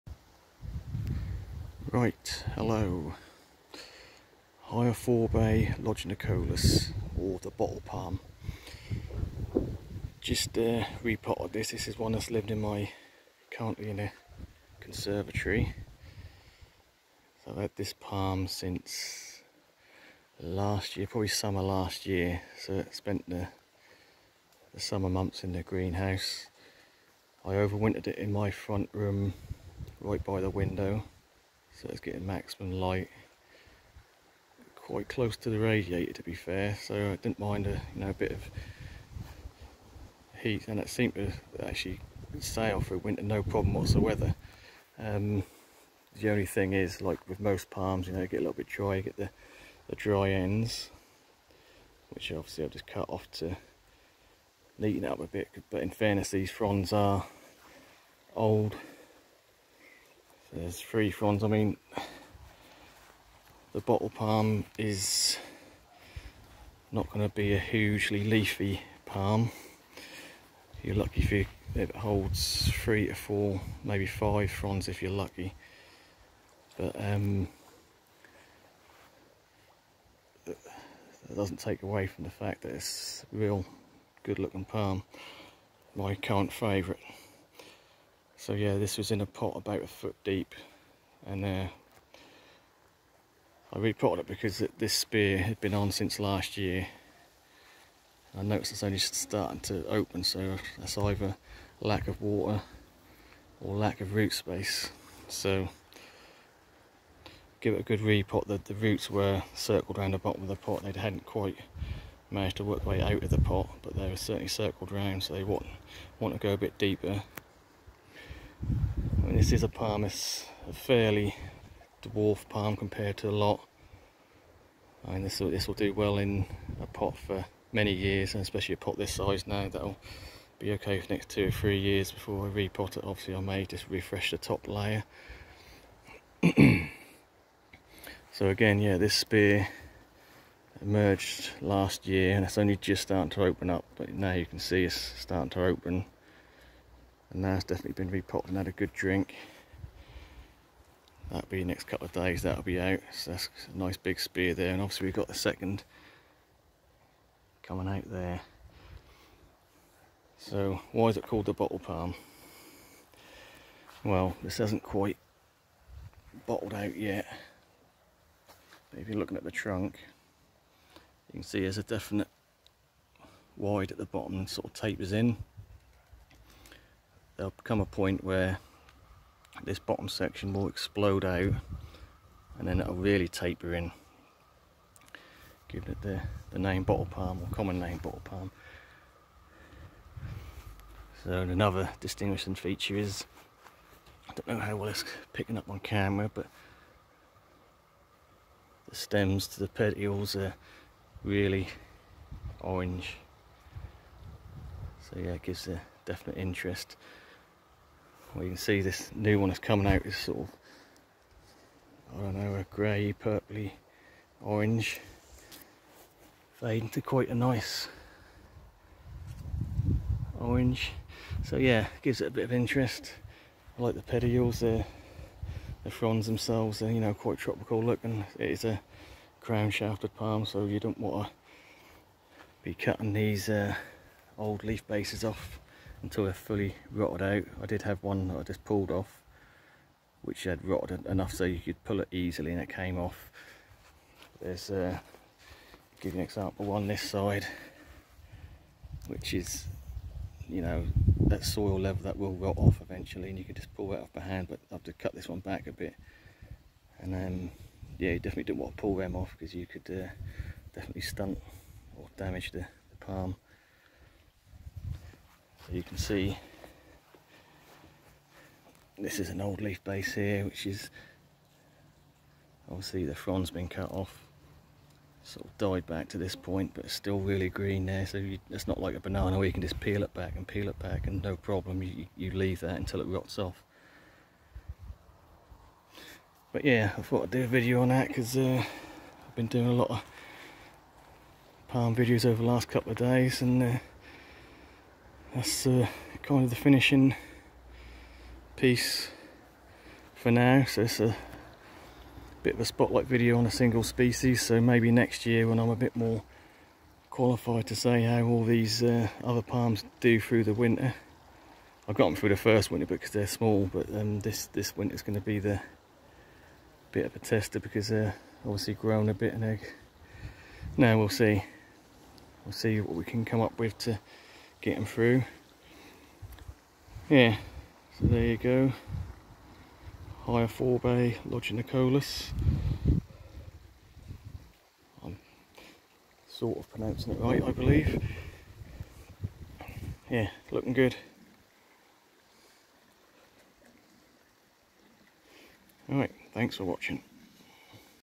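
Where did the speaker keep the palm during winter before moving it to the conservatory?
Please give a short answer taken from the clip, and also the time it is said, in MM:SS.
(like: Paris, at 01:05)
Front room, at 00:28.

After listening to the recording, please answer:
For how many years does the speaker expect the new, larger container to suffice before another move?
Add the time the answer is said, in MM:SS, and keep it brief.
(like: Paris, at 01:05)
2 or 3 years, at 02:11.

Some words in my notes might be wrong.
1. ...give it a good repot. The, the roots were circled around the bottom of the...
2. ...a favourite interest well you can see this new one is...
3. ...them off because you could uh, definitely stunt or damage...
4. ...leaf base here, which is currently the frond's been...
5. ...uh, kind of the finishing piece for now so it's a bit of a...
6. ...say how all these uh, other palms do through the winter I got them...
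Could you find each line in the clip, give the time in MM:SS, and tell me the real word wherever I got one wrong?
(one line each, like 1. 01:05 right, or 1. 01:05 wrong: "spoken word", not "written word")
1. 01:47 right
2. 03:25 wrong: "definite", not "favourite"
3. 04:18 right
4. 04:29 wrong: "obviously", not "currently"
5. 04:55 right
6. 05:07 right.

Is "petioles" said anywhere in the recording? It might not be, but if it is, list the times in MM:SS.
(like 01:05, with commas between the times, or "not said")
03:19, 03:44.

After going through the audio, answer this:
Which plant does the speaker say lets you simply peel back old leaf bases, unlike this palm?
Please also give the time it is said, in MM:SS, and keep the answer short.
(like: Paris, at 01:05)
Banana, at 04:38.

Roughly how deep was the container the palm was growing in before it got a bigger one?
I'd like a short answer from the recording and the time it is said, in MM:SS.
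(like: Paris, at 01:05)
About a foot, at 01:29.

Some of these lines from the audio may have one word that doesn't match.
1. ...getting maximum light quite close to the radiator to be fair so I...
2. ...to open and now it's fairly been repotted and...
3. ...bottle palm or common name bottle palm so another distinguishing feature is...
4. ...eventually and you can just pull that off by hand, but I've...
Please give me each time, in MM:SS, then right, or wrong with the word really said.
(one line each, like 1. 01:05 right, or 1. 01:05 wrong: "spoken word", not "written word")
1. 00:31 right
2. 02:25 wrong: "definitely", not "fairly"
3. 03:06 right
4. 04:12 right.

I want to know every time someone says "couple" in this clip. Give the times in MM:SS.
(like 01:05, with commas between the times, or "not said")
02:31, 04:52.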